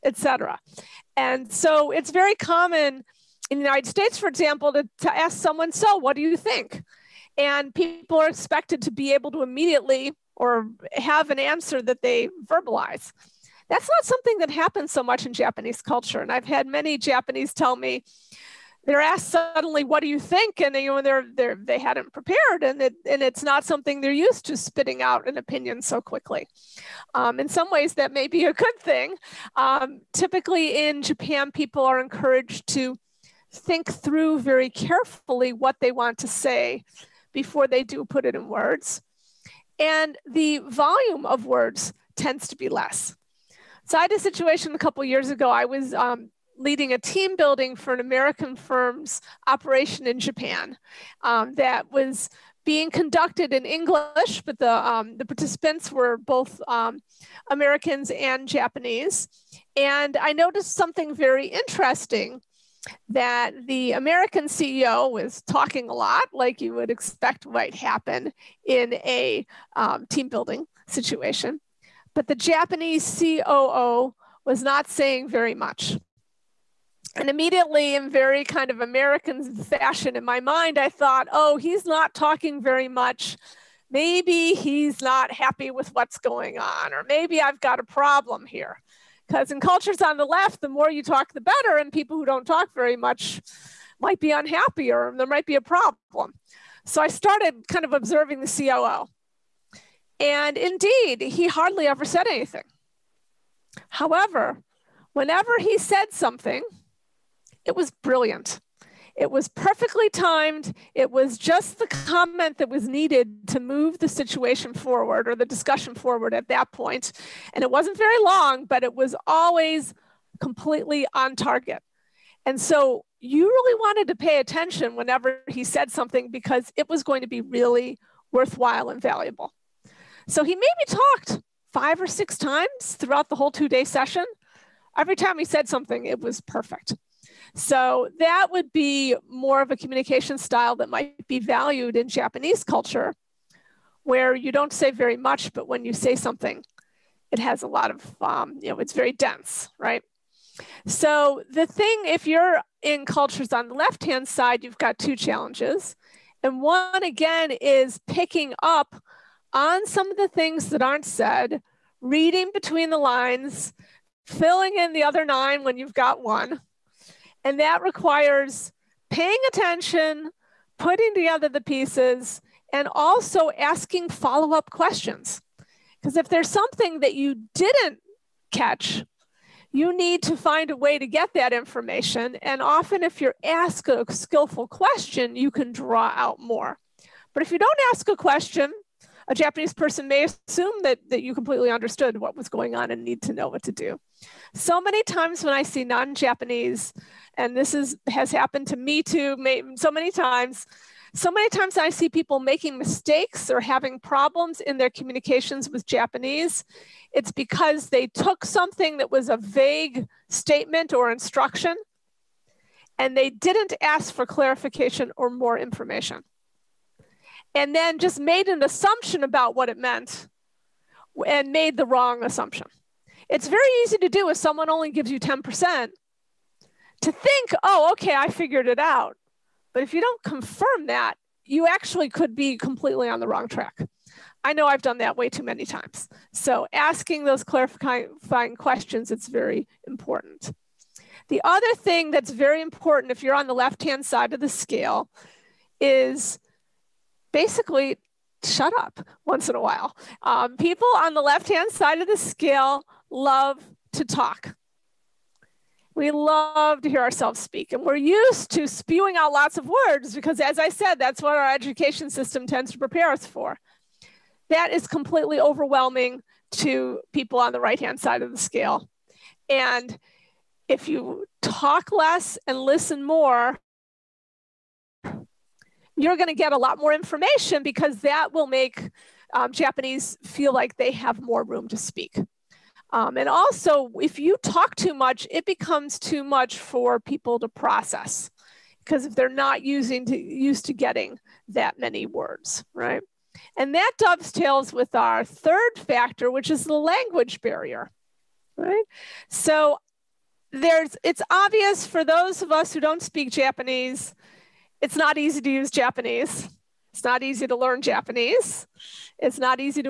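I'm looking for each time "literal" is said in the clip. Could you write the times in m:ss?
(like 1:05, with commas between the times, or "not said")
not said.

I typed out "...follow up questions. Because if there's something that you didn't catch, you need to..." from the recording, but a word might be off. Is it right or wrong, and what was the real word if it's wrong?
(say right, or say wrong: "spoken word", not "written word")
right.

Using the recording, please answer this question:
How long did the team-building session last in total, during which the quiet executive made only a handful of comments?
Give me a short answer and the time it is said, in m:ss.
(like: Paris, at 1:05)
2 days, at 2:13.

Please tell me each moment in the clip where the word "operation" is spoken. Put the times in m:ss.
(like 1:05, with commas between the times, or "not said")
0:49.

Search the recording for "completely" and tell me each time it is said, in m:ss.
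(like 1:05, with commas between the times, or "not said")
2:00, 3:11, 3:52, 4:24.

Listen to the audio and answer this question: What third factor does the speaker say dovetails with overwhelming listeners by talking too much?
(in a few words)
language barrier.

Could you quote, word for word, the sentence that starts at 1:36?
So I started kind of observing the COO.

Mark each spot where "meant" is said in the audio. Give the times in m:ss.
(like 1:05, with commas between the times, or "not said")
3:39.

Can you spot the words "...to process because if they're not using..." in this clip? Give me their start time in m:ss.
4:47.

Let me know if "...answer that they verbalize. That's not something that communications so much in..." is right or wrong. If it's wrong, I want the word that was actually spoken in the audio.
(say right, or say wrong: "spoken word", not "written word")
wrong: "happens", not "communications".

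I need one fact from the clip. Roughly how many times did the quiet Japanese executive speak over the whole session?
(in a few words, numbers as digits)
5 or 6.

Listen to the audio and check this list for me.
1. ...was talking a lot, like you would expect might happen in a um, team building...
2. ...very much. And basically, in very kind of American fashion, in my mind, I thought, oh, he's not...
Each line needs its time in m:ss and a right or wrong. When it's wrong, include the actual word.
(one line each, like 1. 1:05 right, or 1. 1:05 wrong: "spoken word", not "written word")
1. 1:05 right
2. 1:15 wrong: "immediately", not "basically".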